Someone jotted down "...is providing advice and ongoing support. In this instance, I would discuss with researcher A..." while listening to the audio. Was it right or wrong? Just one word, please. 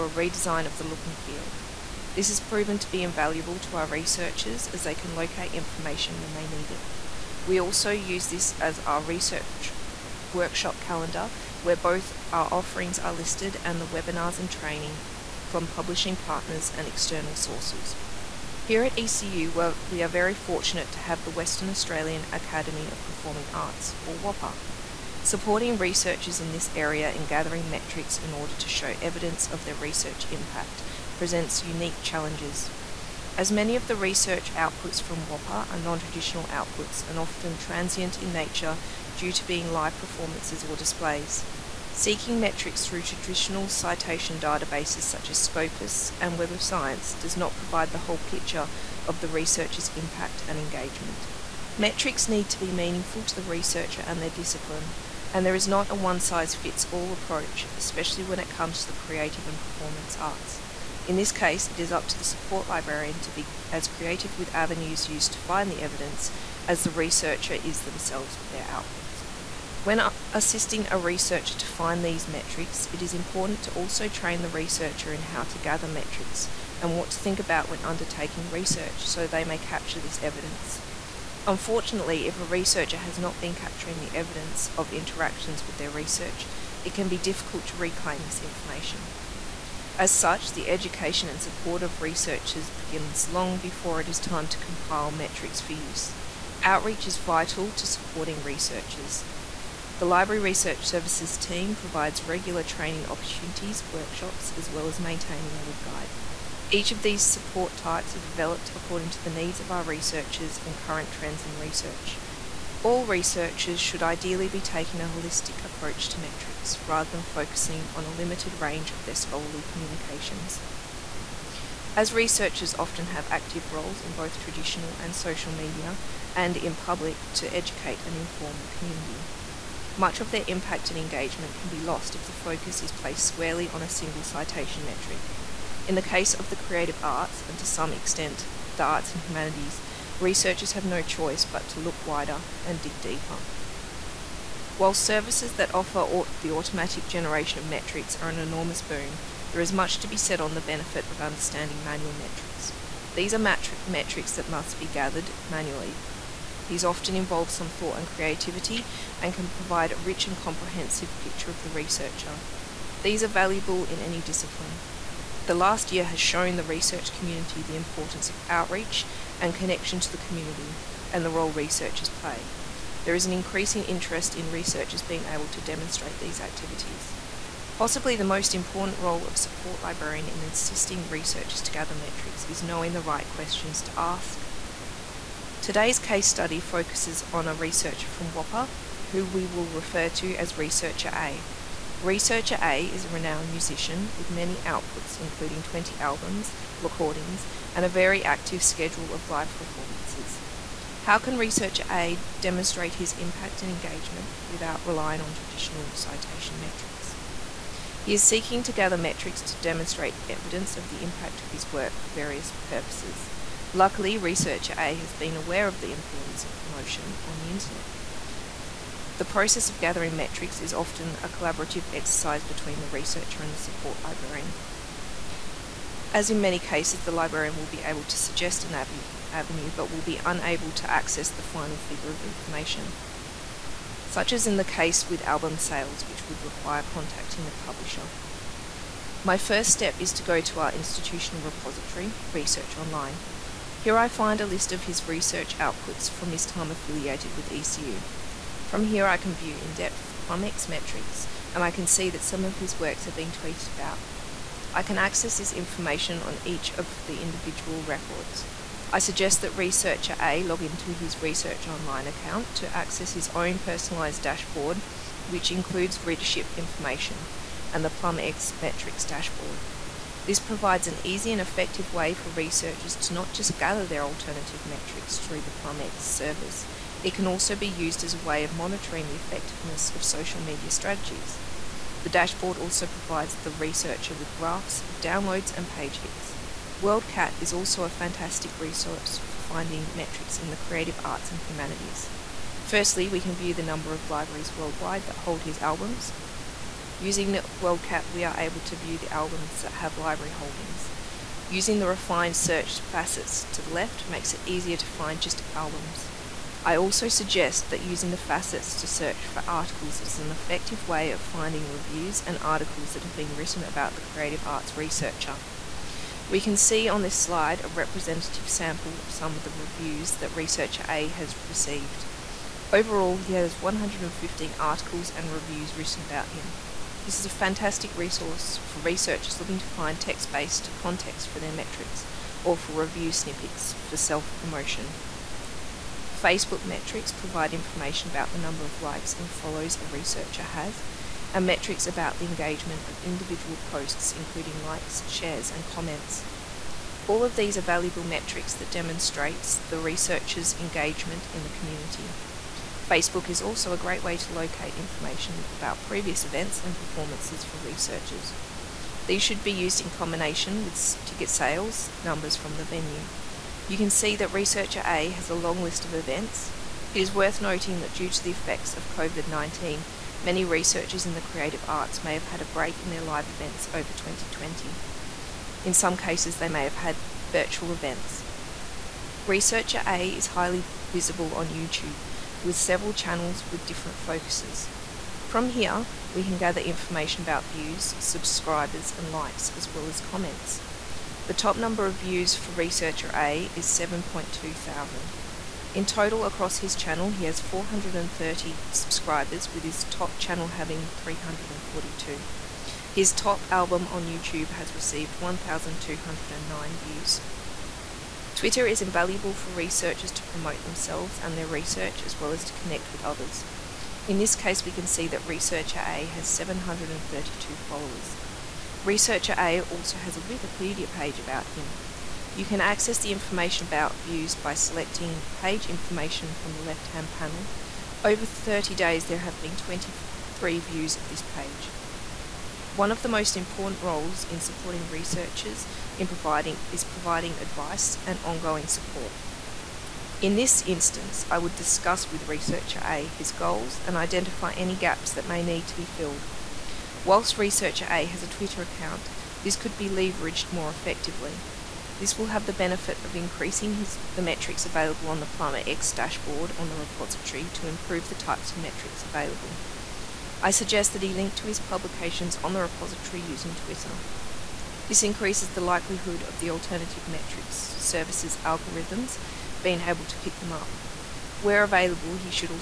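right.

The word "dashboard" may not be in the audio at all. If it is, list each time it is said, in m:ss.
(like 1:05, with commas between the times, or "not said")
4:24, 4:29, 4:42, 7:35.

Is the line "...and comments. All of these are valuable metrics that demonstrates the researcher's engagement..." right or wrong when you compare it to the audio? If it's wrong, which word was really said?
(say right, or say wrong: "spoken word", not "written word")
right.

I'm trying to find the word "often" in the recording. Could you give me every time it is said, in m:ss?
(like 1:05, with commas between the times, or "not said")
0:37, 2:02, 2:36, 3:40.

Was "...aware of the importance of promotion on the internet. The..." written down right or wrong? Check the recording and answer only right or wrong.
right.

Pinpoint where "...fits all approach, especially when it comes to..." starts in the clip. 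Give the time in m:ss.
0:56.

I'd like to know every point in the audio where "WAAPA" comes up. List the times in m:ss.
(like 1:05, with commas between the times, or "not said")
0:24, 0:35, 3:08.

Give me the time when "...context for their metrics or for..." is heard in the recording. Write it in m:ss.
5:30.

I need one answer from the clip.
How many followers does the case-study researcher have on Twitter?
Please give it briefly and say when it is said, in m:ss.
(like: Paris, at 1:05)
732, at 6:56.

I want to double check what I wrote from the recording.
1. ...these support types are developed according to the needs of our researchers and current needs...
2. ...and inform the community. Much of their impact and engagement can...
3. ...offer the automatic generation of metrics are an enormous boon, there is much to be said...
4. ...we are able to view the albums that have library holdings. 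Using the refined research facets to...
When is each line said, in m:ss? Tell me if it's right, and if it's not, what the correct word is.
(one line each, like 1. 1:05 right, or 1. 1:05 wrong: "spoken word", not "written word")
1. 1:47 wrong: "trends", not "needs"
2. 2:08 right
3. 2:25 right
4. 4:58 wrong: "search", not "research".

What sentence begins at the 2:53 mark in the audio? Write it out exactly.
There is an increasing interest in researchers being able to demonstrate these activities.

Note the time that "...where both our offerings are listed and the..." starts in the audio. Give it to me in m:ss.
0:11.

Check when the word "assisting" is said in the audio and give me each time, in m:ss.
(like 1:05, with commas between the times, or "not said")
1:10, 3:00.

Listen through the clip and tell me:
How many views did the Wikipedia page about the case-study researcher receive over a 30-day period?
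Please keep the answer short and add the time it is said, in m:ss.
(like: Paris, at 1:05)
23, at 7:09.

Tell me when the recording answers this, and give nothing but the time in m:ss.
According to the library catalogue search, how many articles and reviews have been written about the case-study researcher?
5:23.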